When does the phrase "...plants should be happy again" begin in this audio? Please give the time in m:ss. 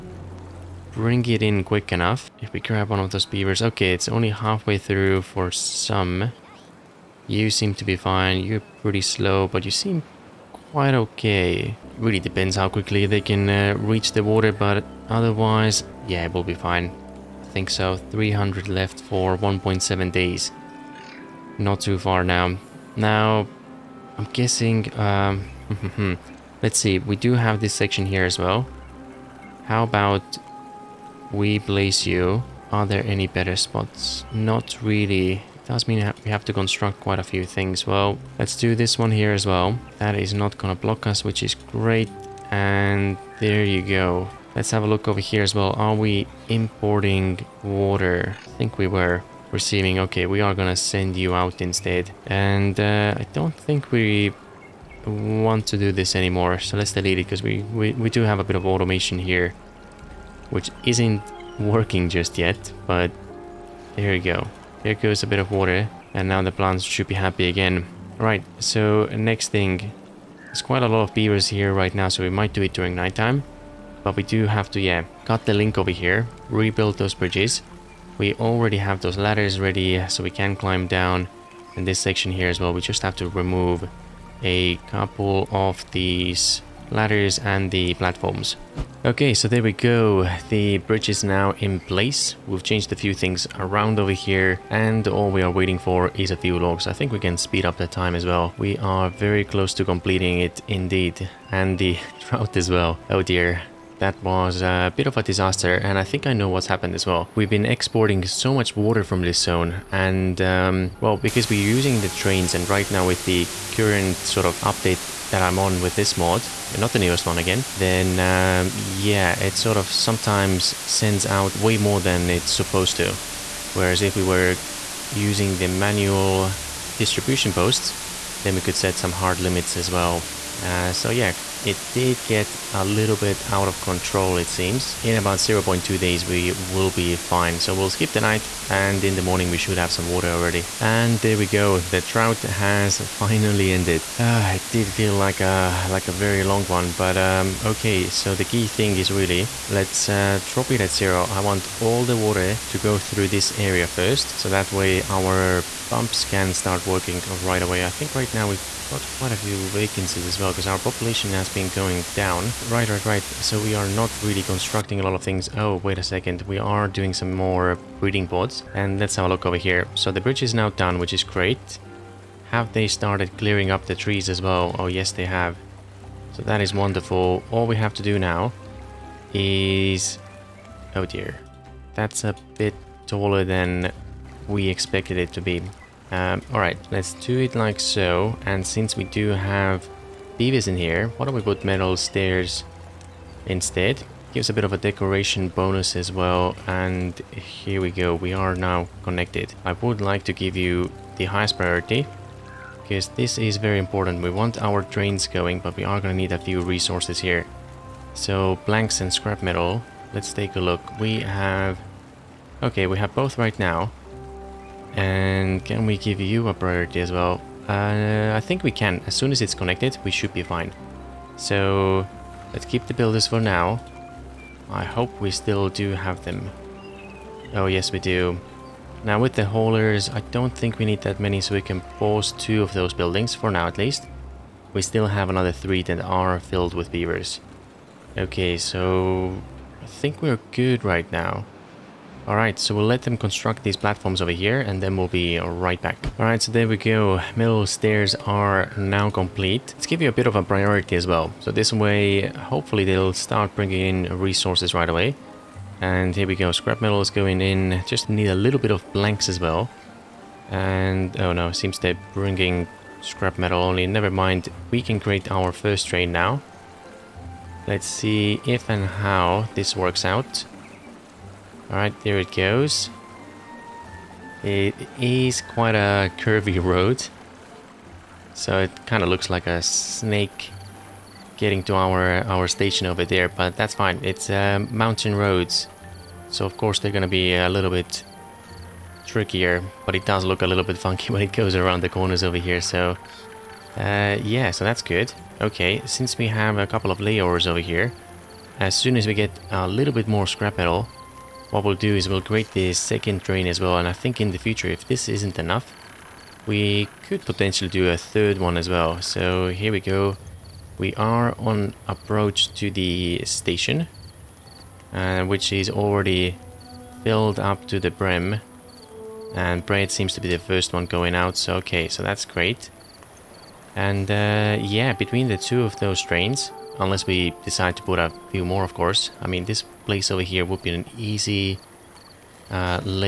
1:06.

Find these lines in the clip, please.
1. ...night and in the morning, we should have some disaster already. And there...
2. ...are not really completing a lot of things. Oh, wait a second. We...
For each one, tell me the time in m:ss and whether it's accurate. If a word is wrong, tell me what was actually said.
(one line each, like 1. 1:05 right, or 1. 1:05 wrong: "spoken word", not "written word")
1. 2:18 wrong: "water", not "disaster"
2. 2:43 wrong: "constructing", not "completing".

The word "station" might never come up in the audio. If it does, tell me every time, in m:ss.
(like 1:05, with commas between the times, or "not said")
4:42, 5:13.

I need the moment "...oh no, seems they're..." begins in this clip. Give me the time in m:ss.
4:21.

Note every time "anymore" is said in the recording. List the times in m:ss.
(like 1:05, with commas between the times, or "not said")
0:56.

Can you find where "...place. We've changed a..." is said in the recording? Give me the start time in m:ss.
1:31.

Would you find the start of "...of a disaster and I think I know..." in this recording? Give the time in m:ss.
1:45.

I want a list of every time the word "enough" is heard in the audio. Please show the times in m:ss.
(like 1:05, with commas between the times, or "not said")
0:01, 5:05.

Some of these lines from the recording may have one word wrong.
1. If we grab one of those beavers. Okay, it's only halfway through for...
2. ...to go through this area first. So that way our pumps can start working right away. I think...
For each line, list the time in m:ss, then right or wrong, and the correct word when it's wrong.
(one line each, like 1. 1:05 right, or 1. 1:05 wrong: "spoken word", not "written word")
1. 0:02 right
2. 2:32 right.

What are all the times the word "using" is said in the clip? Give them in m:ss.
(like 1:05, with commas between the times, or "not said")
1:51, 2:05.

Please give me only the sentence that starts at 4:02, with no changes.
Alright, so we'll let them construct these platforms over here and then we'll be right back.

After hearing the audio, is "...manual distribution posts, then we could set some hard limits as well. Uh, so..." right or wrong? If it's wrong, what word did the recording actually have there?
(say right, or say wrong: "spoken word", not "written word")
right.